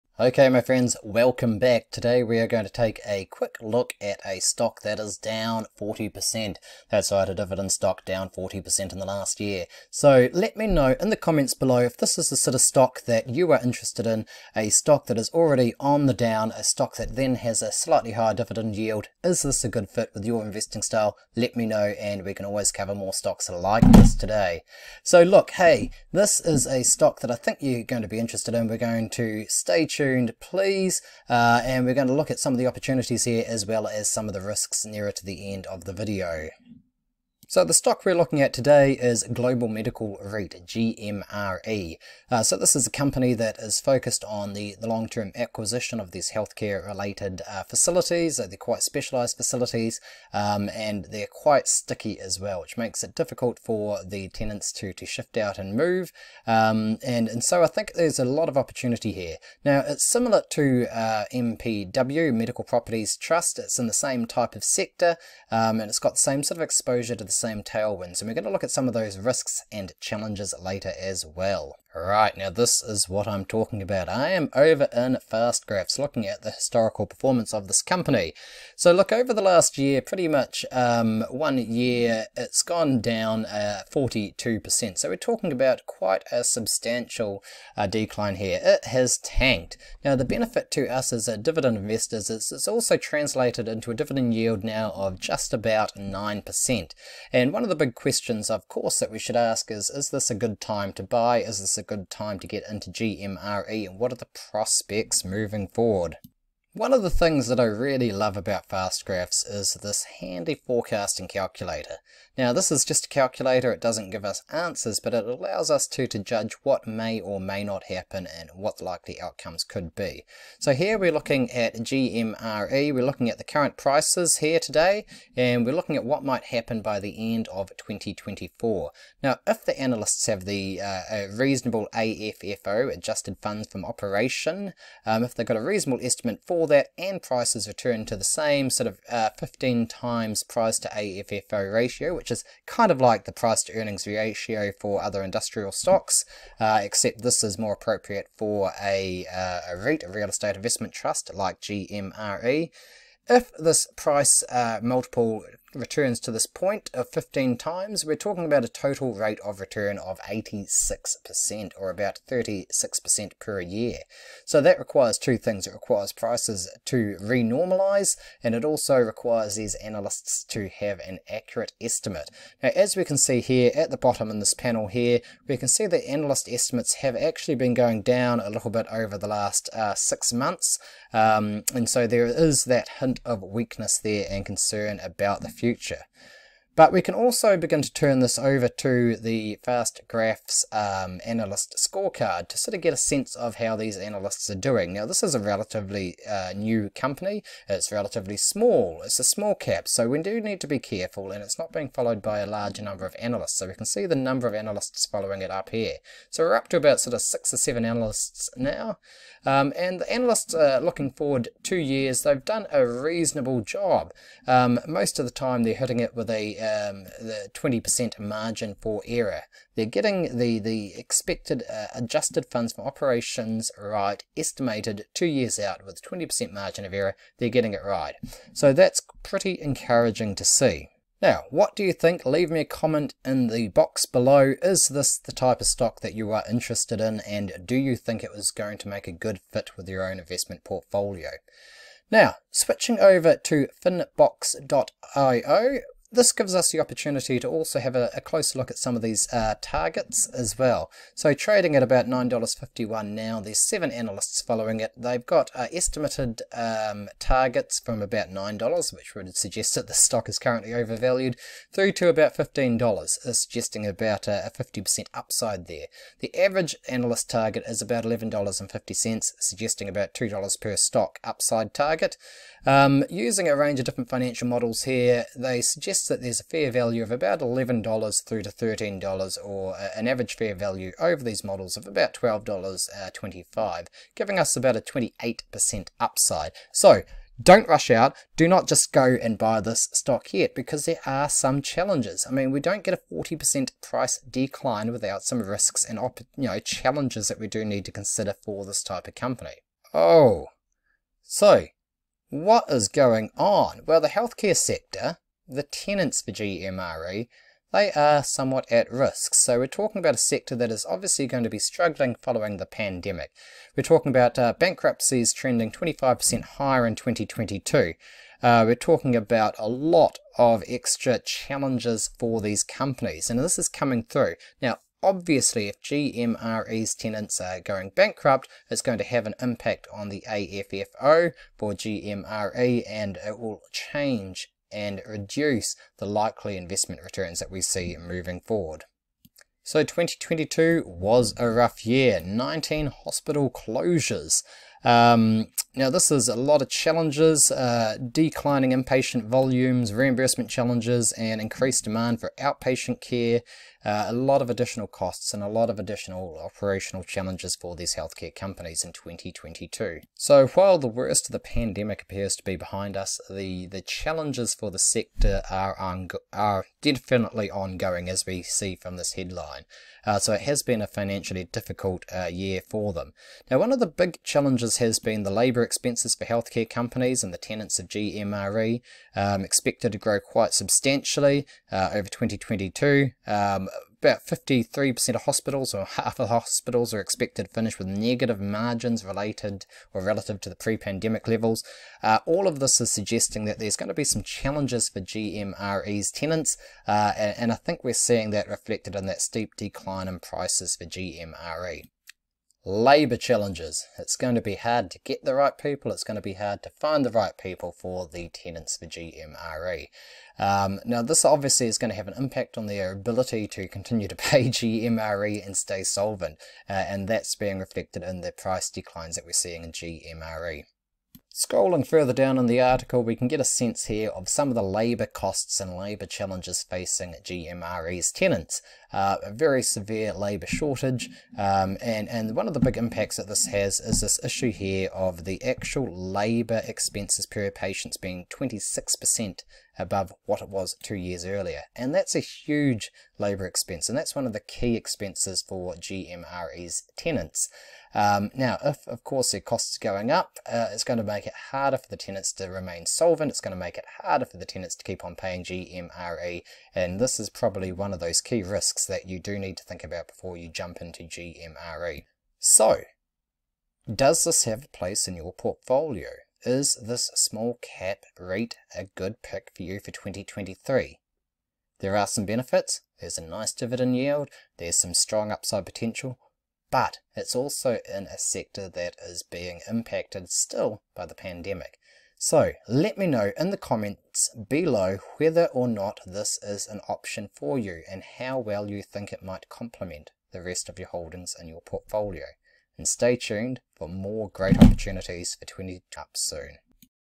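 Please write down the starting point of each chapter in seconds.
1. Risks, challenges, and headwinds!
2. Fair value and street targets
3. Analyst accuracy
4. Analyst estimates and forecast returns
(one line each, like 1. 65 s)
1. 300 s
2. 232 s
3. 188 s
4. 107 s.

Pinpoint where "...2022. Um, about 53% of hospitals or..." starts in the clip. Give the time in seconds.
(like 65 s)
382 s.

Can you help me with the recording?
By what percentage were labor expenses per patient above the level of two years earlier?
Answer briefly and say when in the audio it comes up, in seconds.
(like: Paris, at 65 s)
26%, at 438 s.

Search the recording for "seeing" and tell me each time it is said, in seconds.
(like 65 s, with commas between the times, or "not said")
397 s, 419 s.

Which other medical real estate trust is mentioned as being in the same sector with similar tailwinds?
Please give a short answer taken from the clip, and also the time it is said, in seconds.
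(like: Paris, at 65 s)
Medical Properties Trust, at 62 s.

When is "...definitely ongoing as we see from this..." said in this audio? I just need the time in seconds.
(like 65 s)
366 s.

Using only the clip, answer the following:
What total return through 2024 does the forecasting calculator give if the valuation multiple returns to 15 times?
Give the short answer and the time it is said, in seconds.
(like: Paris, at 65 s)
86%, at 160 s.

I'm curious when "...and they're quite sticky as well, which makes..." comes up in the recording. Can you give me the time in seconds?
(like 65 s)
50 s.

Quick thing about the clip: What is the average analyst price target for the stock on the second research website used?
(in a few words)
$11.50.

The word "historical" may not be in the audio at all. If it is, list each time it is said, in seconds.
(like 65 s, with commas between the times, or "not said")
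76 s.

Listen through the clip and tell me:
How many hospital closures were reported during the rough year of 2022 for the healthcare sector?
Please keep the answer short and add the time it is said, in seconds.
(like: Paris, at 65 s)
19, at 342 s.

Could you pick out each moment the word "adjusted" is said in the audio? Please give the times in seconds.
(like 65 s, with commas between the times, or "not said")
132 s, 221 s.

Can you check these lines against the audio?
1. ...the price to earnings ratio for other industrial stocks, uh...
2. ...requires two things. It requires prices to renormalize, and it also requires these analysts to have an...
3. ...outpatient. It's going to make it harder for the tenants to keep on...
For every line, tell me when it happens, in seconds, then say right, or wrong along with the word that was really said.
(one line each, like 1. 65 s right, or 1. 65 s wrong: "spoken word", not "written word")
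1. 143 s right
2. 164 s right
3. 452 s wrong: "solvent", not "outpatient".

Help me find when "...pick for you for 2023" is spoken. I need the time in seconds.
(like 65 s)
469 s.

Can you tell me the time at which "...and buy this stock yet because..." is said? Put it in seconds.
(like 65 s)
289 s.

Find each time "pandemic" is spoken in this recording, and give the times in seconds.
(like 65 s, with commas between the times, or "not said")
312 s, 361 s, 390 s, 481 s.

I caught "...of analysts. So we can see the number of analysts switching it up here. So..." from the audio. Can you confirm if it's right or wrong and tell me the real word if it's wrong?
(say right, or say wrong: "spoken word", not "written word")
wrong: "following", not "switching".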